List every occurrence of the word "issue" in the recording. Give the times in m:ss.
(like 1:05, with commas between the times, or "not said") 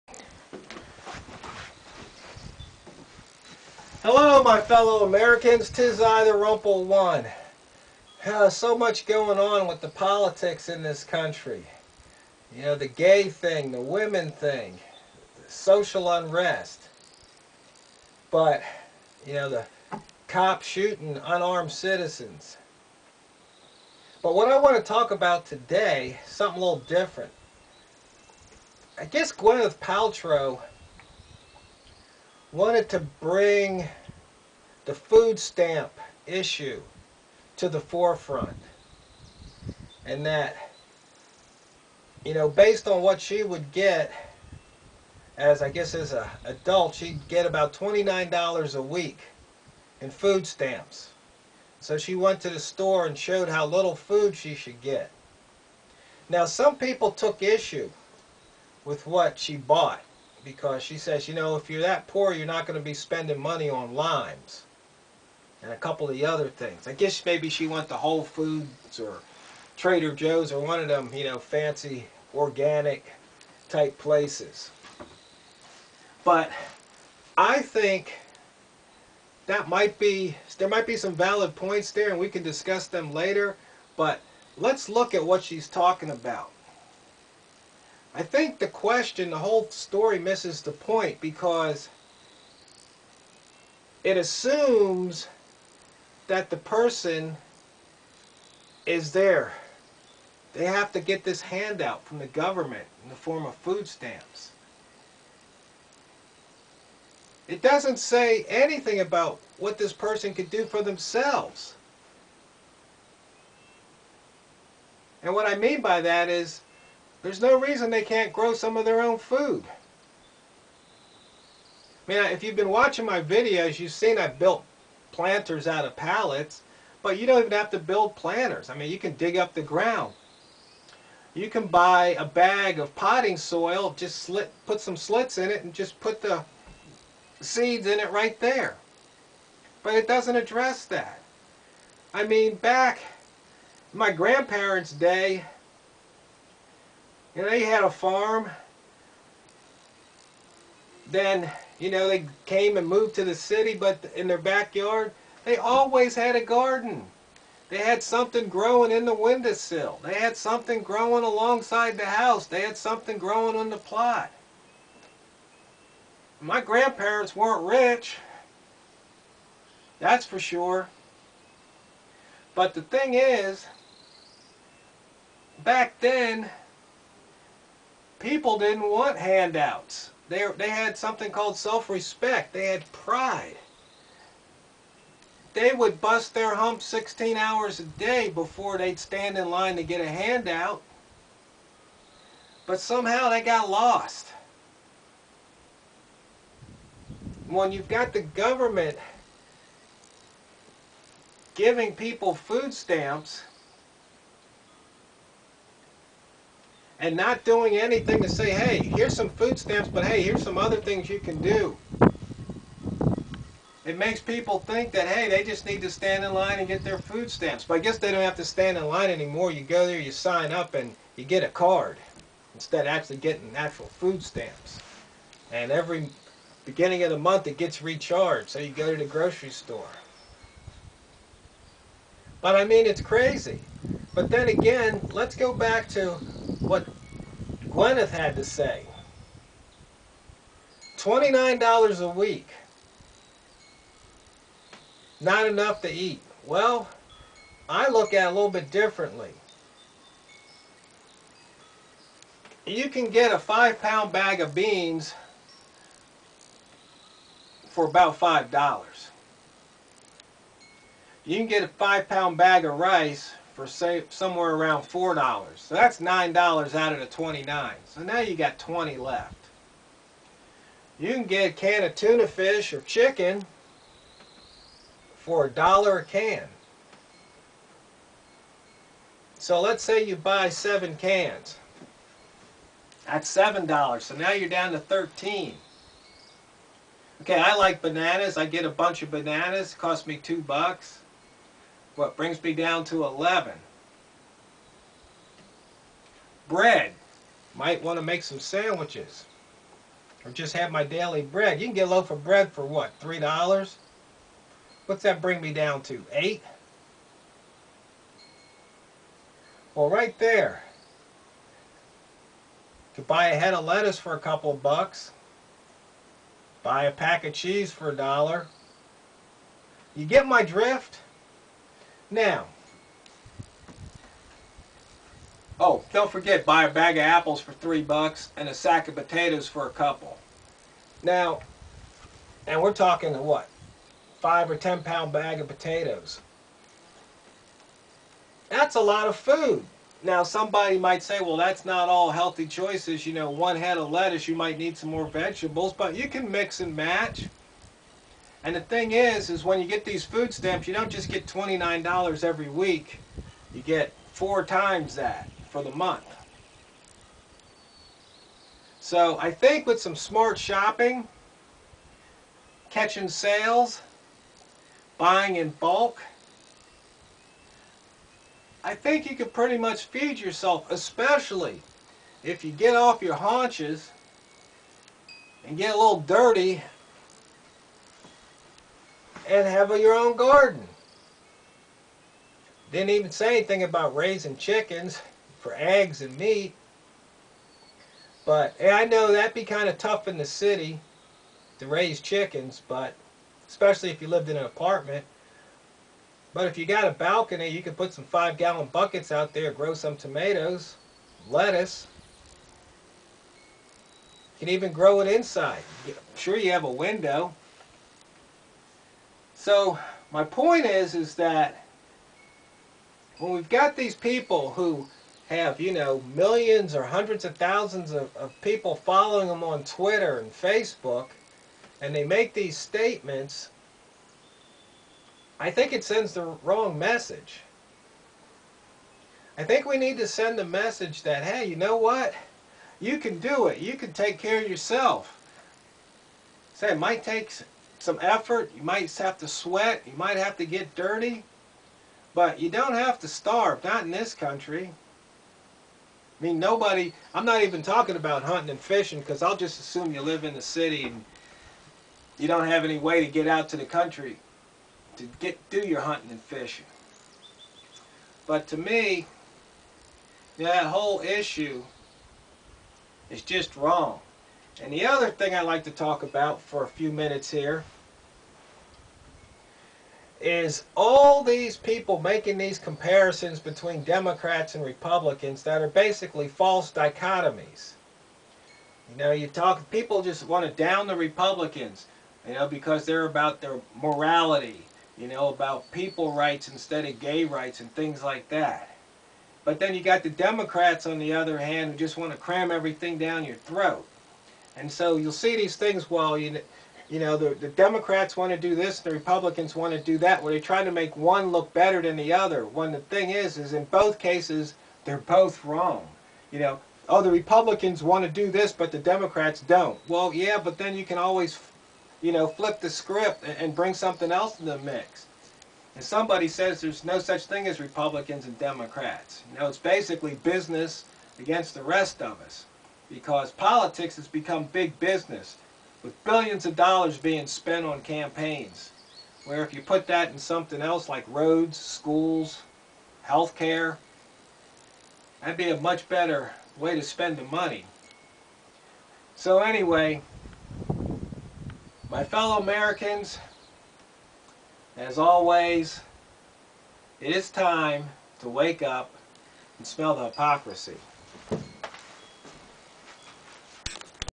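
0:36, 0:57, 7:41.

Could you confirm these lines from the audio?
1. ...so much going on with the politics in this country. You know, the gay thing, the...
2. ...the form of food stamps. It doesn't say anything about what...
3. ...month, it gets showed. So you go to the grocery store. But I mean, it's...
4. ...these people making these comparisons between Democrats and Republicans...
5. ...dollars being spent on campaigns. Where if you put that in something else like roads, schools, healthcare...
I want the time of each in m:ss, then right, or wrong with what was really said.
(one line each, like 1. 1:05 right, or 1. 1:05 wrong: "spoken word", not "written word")
1. 0:08 right
2. 1:43 right
3. 3:47 wrong: "recharged", not "showed"
4. 7:51 right
5. 8:46 right.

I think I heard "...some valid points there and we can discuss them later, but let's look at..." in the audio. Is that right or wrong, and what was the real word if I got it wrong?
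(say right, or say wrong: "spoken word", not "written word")
right.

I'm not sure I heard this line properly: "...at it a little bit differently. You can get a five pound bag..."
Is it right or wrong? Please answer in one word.
right.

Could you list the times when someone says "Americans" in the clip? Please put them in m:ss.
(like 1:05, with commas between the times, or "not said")
0:05, 9:02.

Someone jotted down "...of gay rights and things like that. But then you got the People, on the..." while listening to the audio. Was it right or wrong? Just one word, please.
wrong.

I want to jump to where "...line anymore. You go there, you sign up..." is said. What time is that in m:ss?
3:38.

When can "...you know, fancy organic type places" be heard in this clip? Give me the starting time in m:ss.
1:11.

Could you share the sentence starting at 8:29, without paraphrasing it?
Well, yeah, but then you can always, you know, flip the script and, and bring something else in the mix.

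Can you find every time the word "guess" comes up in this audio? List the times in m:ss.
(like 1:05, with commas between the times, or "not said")
0:29, 0:45, 1:06, 3:37.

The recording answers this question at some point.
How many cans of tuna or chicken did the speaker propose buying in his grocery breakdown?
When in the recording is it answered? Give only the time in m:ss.
4:40.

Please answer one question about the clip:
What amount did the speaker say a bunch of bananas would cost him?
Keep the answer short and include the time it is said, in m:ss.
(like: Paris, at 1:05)
$2, at 4:50.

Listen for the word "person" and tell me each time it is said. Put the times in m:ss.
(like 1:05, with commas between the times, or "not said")
1:36, 1:49.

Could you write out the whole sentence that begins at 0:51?
So she went to the store and showed how little food she should get.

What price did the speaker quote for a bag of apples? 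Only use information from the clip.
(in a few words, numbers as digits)
$3.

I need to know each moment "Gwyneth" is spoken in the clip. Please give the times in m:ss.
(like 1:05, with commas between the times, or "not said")
0:29, 3:57.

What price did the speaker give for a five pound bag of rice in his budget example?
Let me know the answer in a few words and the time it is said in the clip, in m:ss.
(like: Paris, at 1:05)
$4, at 4:24.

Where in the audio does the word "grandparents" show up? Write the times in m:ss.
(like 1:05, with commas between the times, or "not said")
2:24, 2:46.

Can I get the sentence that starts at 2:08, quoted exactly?
I mean, you can dig up the ground.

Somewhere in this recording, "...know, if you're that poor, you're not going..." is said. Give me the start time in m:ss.
1:01.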